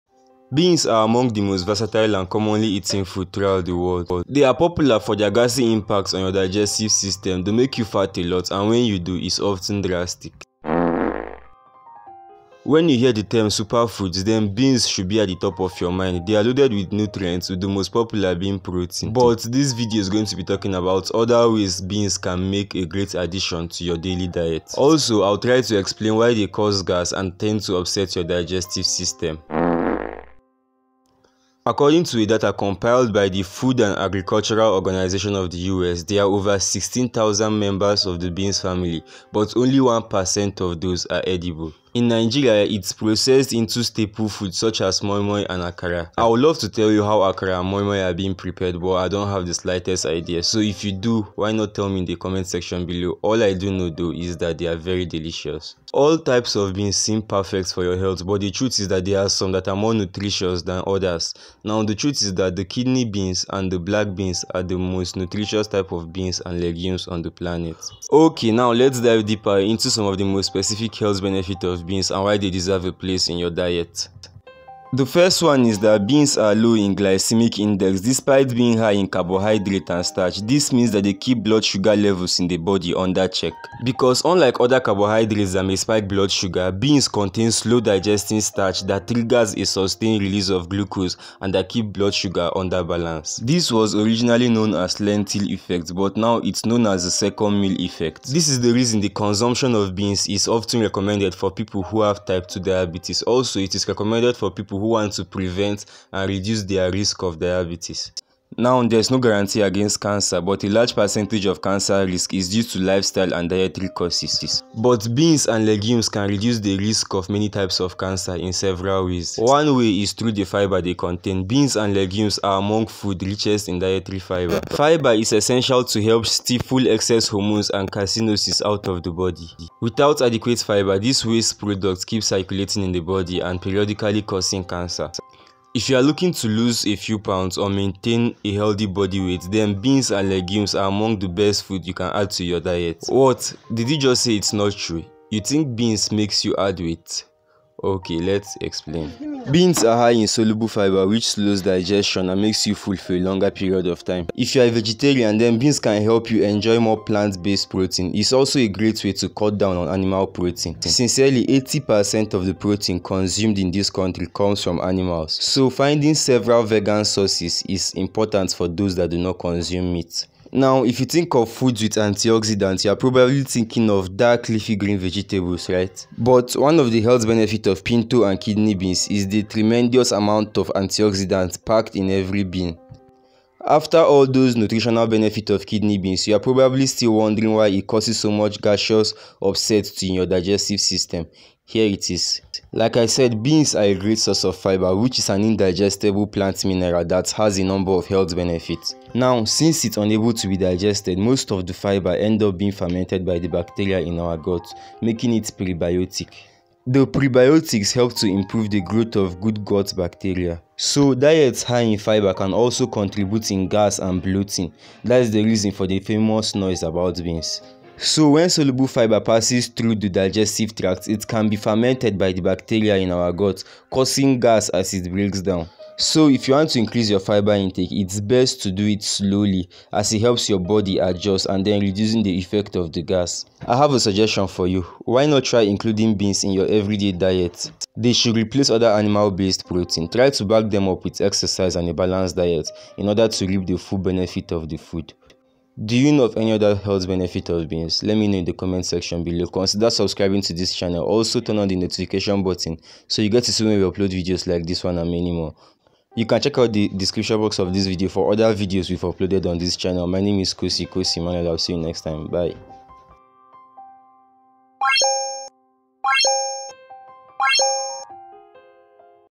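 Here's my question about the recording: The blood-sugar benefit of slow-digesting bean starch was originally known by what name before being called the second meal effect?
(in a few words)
lentil effect.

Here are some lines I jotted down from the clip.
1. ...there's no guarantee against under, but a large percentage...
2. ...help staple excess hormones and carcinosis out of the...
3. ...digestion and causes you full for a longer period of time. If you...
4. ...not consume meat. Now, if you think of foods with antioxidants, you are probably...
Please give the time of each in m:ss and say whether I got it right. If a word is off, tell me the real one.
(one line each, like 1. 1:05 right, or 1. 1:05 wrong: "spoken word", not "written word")
1. 1:48 wrong: "cancer", not "under"
2. 2:06 wrong: "stifle", not "staple"
3. 2:31 wrong: "makes", not "causes"
4. 2:49 right.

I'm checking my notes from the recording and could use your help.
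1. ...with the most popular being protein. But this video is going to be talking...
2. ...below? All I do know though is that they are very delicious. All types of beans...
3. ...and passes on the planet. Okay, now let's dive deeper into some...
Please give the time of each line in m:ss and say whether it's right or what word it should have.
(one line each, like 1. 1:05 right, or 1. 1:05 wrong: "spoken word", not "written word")
1. 0:17 right
2. 0:52 right
3. 1:06 wrong: "legumes", not "passes".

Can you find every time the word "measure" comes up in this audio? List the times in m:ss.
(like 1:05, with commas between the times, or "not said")
not said.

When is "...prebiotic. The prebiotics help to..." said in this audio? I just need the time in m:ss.
3:25.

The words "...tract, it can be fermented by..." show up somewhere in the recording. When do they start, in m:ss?
3:40.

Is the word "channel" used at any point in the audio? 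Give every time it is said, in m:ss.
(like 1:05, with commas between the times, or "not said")
4:10, 4:19.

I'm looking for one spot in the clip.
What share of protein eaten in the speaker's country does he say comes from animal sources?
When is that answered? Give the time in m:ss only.
2:41.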